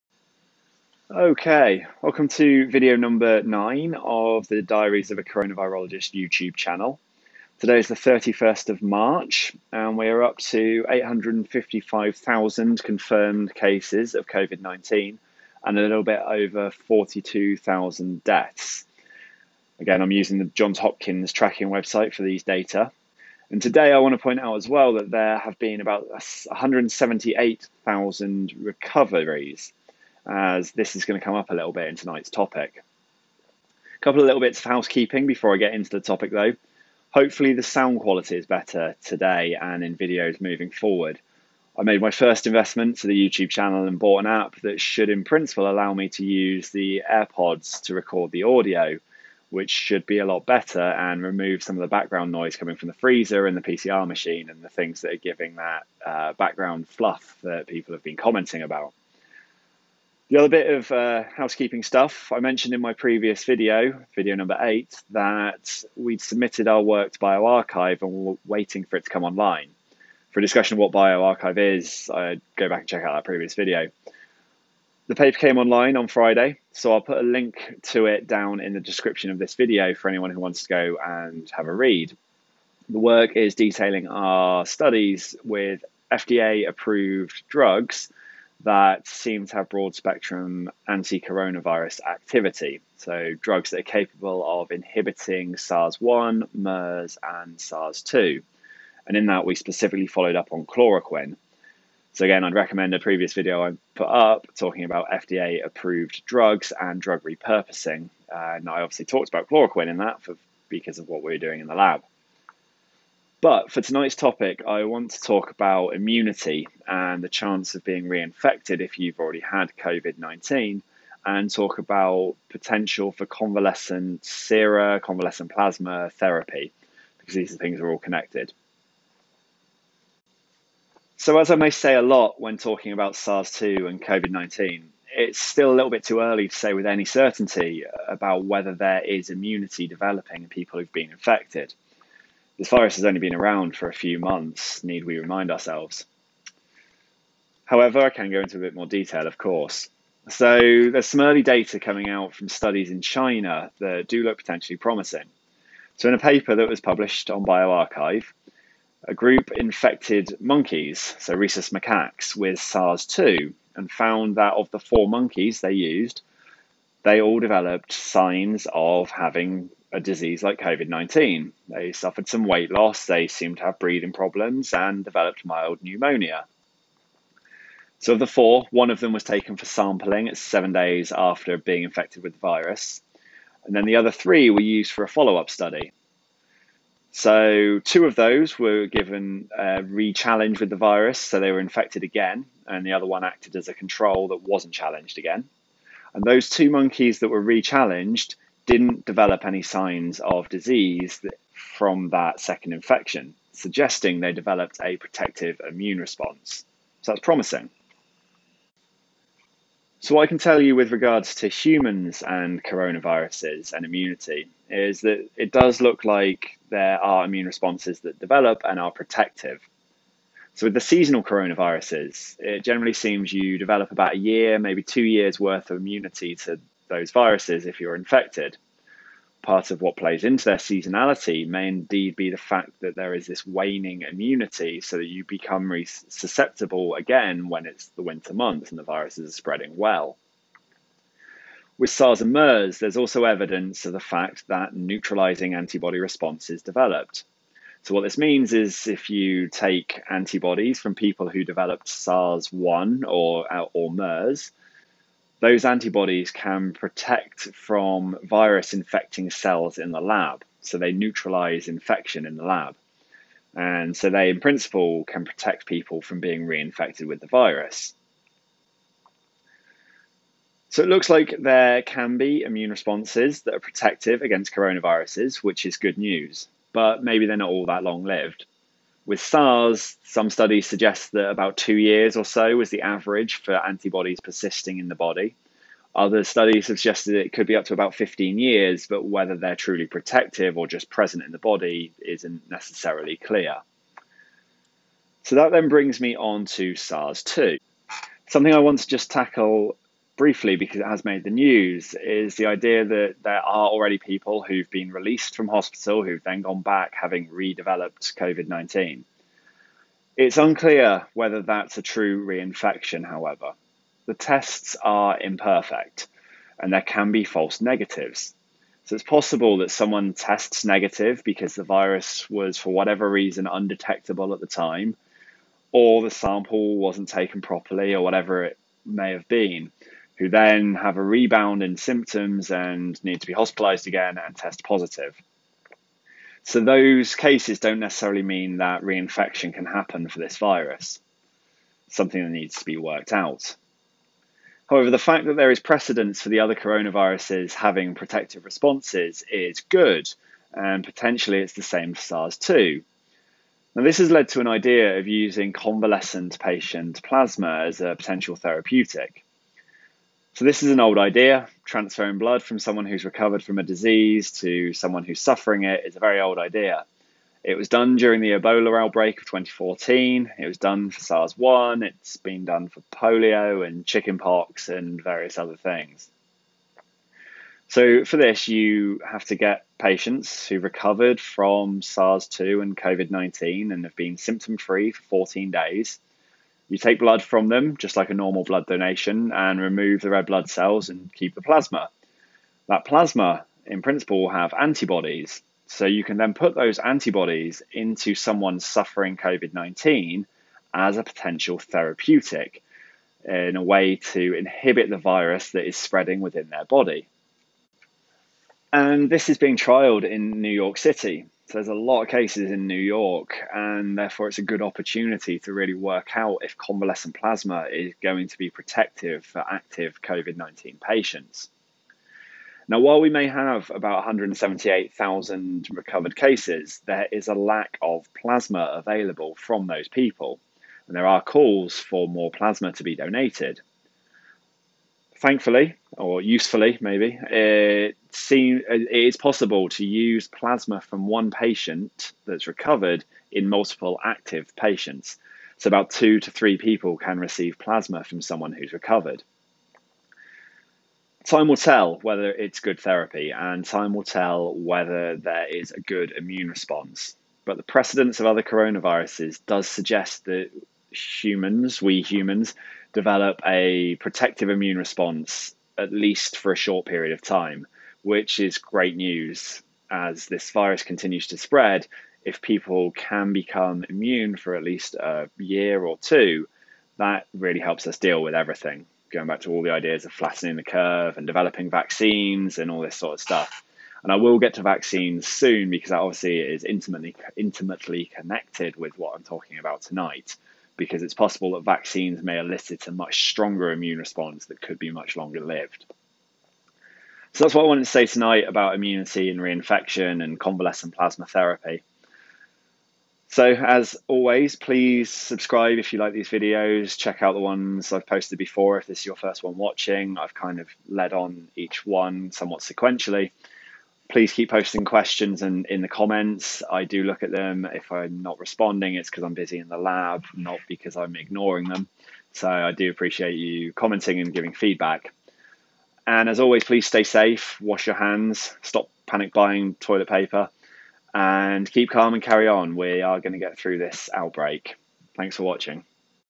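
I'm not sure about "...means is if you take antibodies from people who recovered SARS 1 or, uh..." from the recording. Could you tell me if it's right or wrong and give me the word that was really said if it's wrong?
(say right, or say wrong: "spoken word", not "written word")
wrong: "developed", not "recovered".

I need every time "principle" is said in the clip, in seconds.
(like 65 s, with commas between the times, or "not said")
45 s, 264 s, 393 s.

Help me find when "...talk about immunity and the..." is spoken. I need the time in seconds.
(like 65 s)
115 s.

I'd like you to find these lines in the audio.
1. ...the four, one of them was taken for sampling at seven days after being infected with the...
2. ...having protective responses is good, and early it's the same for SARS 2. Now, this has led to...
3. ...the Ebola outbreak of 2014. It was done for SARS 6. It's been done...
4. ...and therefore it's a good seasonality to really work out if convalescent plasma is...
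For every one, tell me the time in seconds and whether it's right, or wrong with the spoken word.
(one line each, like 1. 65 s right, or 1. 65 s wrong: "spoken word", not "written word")
1. 178 s right
2. 347 s wrong: "potentially", not "early"
3. 368 s wrong: "1", not "6"
4. 413 s wrong: "opportunity", not "seasonality".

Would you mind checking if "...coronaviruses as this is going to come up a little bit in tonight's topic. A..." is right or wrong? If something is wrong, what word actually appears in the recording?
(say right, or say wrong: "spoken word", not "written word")
wrong: "recoveries", not "coronaviruses".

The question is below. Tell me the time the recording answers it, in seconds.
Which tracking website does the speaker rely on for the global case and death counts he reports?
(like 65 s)
20 s.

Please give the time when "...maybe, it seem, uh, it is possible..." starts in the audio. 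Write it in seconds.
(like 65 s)
436 s.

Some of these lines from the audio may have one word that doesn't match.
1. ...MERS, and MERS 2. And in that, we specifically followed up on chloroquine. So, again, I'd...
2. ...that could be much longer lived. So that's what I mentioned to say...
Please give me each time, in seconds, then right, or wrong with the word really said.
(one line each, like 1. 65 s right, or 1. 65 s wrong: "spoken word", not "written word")
1. 96 s wrong: "SARS", not "MERS"
2. 494 s wrong: "wanted", not "mentioned".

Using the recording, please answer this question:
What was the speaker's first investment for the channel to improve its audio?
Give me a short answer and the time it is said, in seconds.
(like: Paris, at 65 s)
An app, at 44 s.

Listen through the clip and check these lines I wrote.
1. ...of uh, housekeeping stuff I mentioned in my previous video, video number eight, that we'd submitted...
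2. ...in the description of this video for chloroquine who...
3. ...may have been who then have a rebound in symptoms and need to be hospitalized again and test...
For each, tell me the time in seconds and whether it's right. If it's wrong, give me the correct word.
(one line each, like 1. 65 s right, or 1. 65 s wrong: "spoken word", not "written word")
1. 60 s right
2. 78 s wrong: "anyone", not "chloroquine"
3. 328 s right.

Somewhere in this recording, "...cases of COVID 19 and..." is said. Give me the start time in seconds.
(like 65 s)
13 s.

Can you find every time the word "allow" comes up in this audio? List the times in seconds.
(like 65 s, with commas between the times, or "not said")
45 s.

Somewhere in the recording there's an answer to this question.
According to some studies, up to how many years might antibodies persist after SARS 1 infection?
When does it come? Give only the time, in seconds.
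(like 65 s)
287 s.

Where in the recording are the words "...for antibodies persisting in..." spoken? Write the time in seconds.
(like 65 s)
283 s.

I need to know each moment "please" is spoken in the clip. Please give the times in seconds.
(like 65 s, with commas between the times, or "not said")
504 s, 514 s, 526 s.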